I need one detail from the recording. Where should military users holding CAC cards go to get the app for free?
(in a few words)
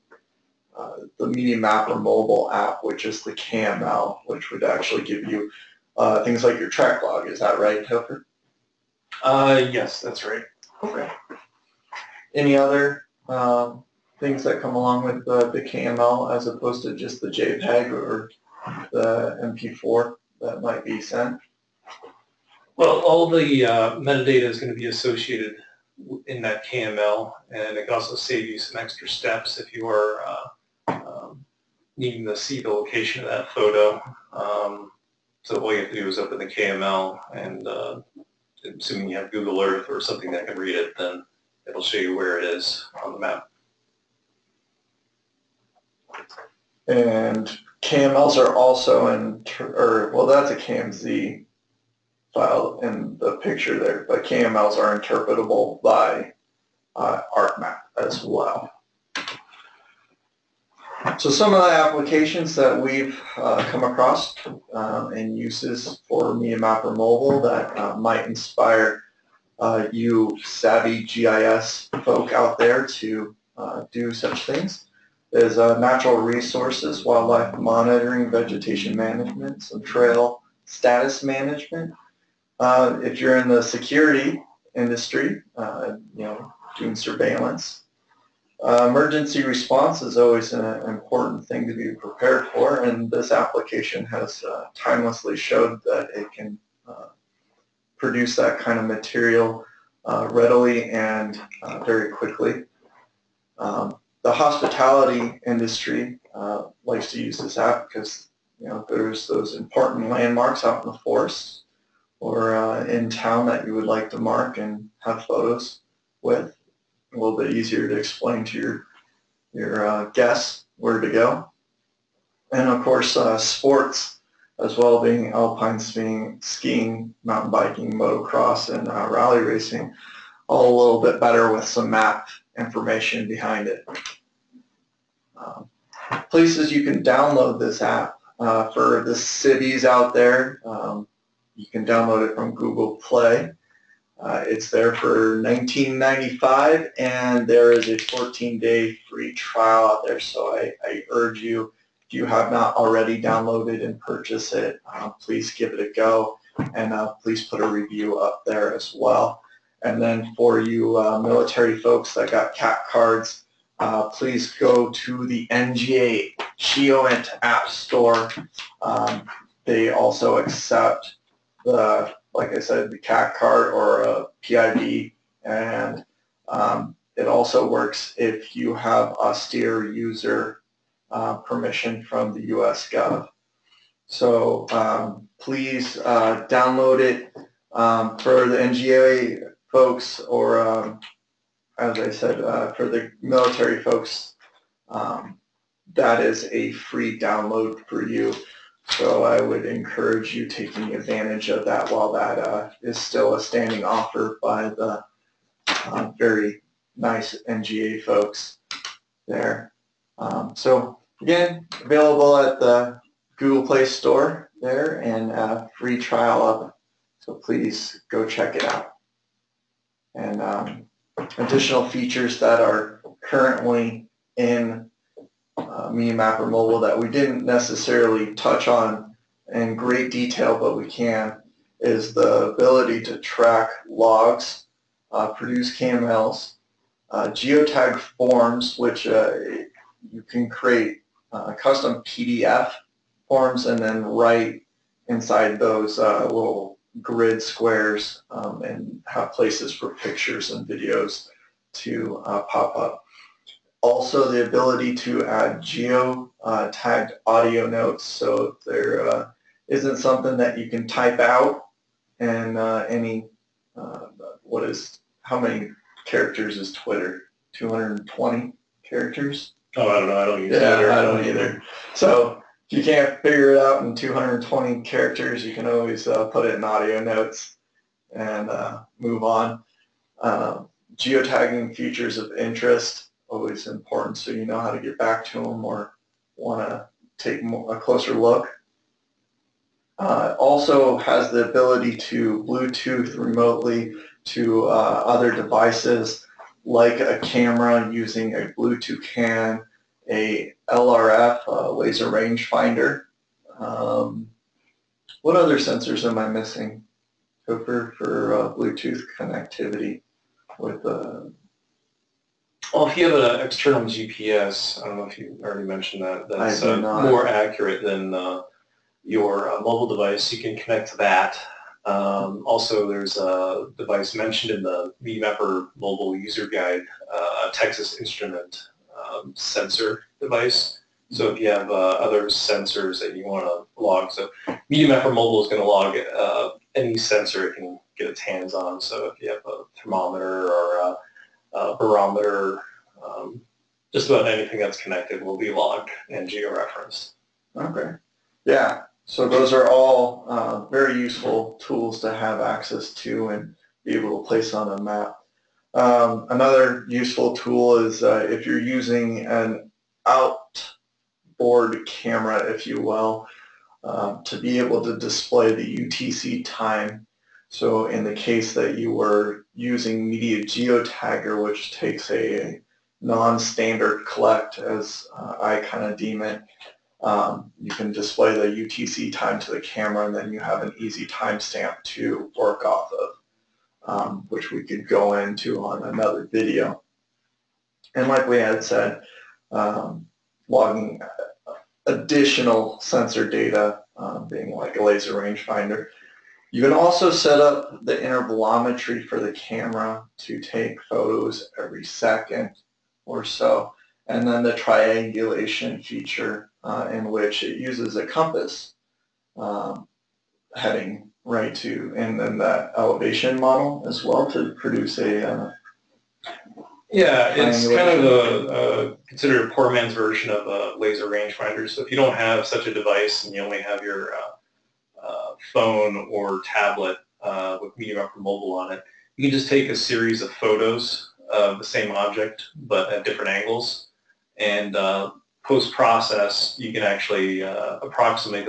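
NGA Geoint App Store.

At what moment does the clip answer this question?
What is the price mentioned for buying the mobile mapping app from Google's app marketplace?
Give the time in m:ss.
2:25.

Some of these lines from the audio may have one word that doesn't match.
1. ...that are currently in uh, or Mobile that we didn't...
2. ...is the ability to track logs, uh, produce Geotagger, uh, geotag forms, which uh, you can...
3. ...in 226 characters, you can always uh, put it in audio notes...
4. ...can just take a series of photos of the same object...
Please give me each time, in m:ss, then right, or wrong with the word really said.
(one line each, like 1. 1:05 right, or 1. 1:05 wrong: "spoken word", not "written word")
1. 3:42 right
2. 3:51 wrong: "KMLs", not "Geotagger"
3. 4:33 wrong: "220", not "226"
4. 7:09 right.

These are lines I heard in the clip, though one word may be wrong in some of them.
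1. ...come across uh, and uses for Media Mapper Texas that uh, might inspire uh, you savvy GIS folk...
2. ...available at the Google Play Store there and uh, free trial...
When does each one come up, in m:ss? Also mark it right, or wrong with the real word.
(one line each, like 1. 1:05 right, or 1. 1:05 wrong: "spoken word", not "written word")
1. 1:03 wrong: "Mobile", not "Texas"
2. 3:31 right.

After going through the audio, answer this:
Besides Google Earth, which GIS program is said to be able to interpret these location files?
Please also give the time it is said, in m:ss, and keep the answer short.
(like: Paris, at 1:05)
ArcMap, at 0:57.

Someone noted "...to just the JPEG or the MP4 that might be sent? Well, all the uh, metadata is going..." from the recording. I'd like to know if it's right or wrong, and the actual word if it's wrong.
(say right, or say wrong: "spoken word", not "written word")
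right.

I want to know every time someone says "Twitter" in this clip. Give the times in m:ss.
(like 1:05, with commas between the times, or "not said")
4:26, 4:30.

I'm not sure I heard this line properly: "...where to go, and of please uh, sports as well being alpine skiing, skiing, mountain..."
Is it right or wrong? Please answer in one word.
wrong.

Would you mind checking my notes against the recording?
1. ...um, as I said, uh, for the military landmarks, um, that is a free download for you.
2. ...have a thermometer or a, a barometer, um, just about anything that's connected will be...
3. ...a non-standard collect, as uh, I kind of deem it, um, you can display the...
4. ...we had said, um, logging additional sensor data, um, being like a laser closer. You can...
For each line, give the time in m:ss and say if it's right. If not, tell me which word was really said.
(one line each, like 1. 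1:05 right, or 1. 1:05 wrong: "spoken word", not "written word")
1. 3:10 wrong: "folks", not "landmarks"
2. 5:39 right
3. 6:12 right
4. 6:28 wrong: "rangefinder", not "closer".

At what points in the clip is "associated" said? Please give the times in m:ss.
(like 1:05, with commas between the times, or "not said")
0:24.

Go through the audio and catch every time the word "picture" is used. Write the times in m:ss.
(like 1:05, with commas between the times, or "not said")
0:53, 4:09.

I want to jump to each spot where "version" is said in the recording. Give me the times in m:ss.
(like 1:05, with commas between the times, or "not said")
6:59.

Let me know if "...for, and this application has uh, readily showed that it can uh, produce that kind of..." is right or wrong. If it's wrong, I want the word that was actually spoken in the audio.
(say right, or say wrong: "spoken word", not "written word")
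wrong: "timelessly", not "readily".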